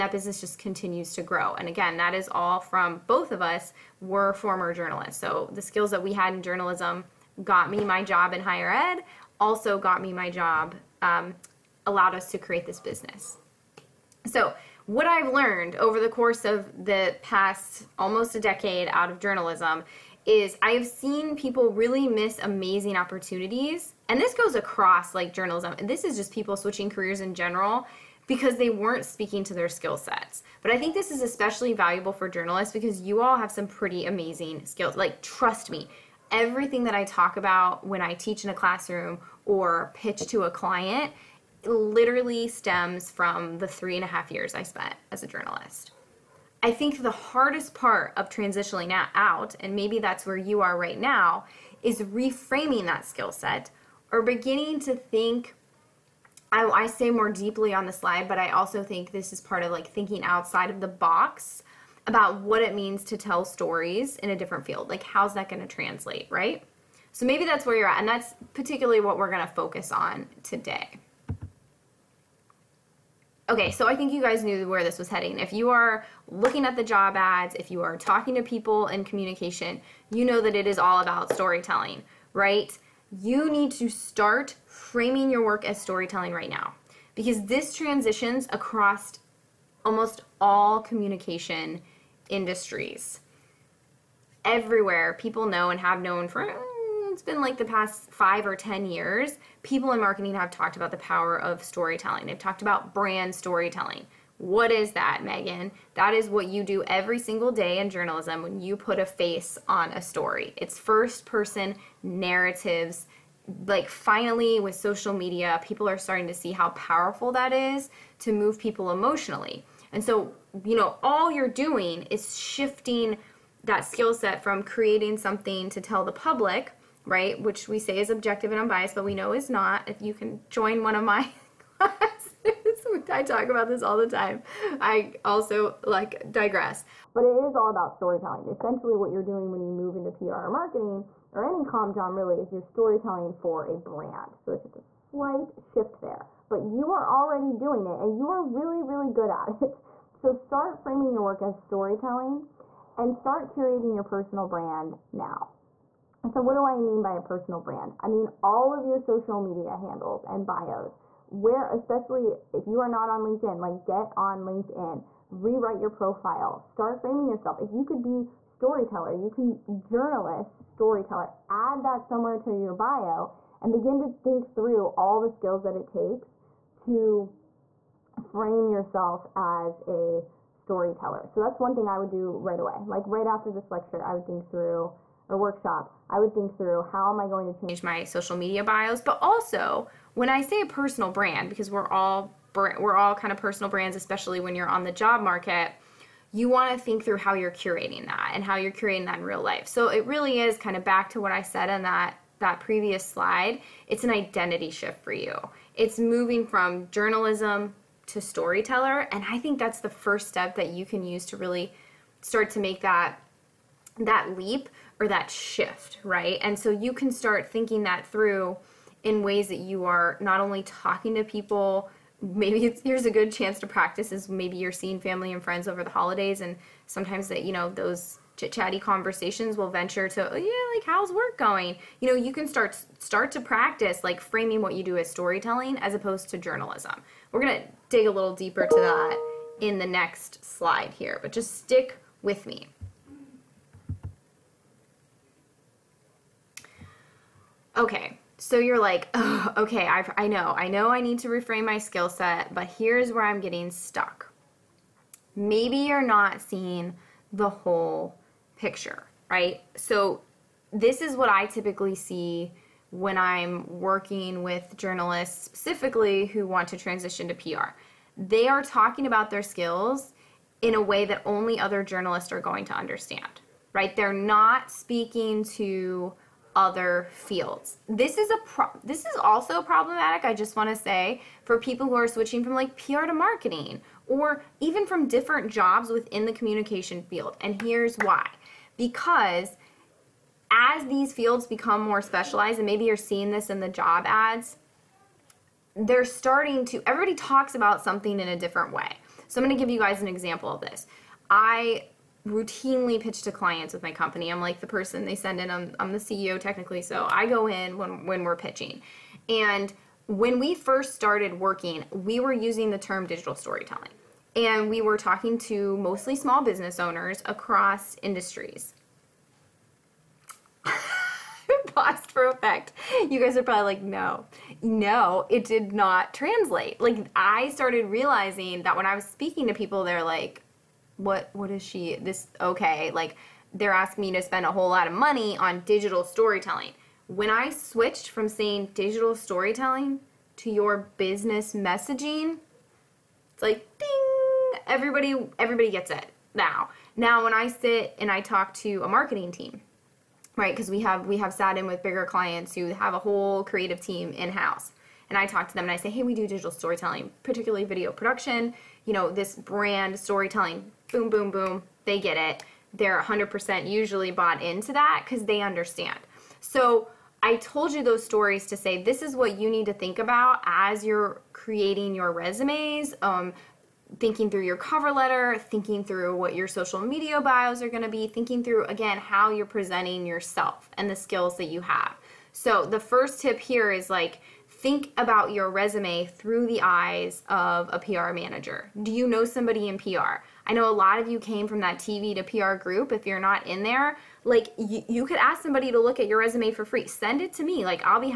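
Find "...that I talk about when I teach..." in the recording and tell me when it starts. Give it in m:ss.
0:36.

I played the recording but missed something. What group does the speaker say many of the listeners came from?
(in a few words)
TV to PR.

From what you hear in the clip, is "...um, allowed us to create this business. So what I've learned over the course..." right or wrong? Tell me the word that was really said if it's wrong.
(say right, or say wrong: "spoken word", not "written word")
right.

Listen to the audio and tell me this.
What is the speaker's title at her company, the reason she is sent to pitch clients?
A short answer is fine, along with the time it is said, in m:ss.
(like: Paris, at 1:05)
CEO, at 5:05.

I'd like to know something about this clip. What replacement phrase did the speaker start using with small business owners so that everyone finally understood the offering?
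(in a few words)
your business messaging.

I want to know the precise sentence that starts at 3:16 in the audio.
You want to think through how you're curating that and how you're curating that in real life.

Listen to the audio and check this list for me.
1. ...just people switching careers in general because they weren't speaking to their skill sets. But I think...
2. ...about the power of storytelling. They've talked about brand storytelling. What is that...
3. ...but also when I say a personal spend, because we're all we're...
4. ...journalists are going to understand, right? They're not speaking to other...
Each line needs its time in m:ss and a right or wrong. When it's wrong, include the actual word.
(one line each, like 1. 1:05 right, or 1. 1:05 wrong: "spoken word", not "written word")
1. 0:26 right
2. 1:40 right
3. 3:09 wrong: "brand", not "spend"
4. 4:31 right.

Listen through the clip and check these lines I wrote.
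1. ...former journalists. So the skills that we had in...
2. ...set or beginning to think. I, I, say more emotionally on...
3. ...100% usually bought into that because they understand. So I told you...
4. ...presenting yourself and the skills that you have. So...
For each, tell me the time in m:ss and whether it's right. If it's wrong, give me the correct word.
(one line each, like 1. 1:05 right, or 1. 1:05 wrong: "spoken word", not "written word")
1. 0:04 right
2. 0:53 wrong: "deeply", not "emotionally"
3. 6:03 right
4. 6:19 right.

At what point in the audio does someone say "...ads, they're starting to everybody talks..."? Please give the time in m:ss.
4:54.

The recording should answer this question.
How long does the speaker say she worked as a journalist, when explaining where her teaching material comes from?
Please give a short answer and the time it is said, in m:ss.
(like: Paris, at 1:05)
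3.5 years, at 0:43.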